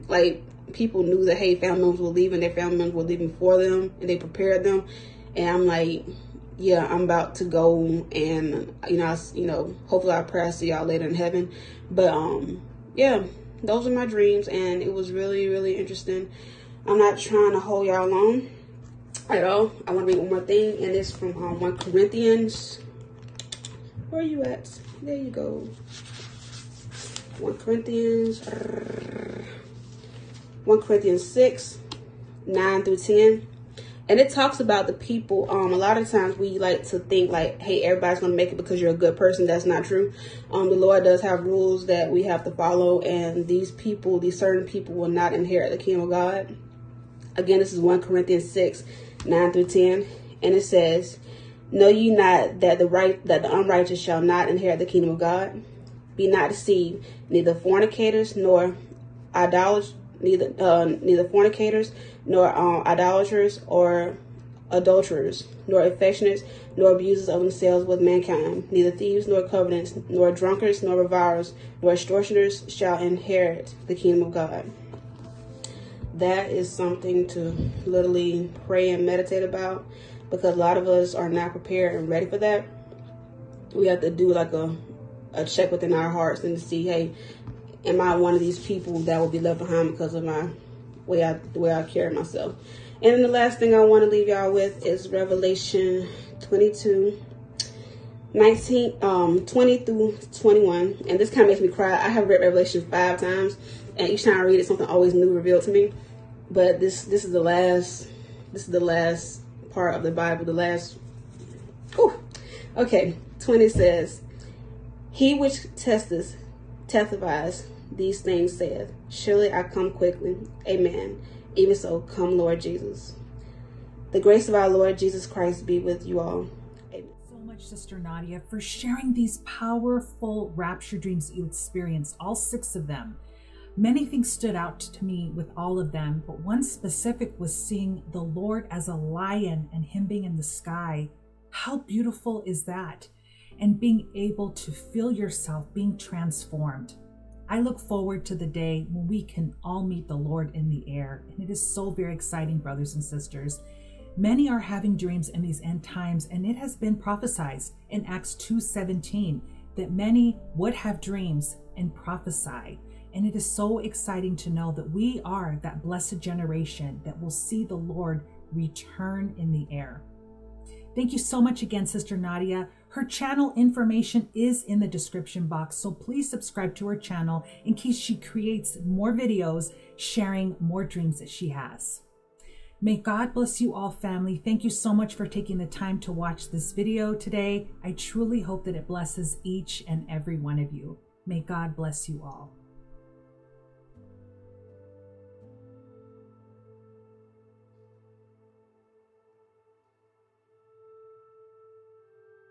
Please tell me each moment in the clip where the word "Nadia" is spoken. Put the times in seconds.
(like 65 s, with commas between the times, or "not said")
127 s, 172 s.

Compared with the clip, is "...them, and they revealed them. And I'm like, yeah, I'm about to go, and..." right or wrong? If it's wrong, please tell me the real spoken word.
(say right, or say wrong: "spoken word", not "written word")
wrong: "prepared", not "revealed".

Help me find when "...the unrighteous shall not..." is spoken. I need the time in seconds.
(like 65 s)
53 s.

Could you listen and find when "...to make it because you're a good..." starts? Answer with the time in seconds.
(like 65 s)
38 s.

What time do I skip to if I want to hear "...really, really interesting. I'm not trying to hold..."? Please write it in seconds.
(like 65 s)
15 s.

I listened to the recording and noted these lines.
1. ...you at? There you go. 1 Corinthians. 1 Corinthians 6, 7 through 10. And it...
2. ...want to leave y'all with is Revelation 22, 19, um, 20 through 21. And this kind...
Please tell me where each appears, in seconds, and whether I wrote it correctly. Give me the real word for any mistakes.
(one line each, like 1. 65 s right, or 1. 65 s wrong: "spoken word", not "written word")
1. 24 s wrong: "9", not "7"
2. 93 s right.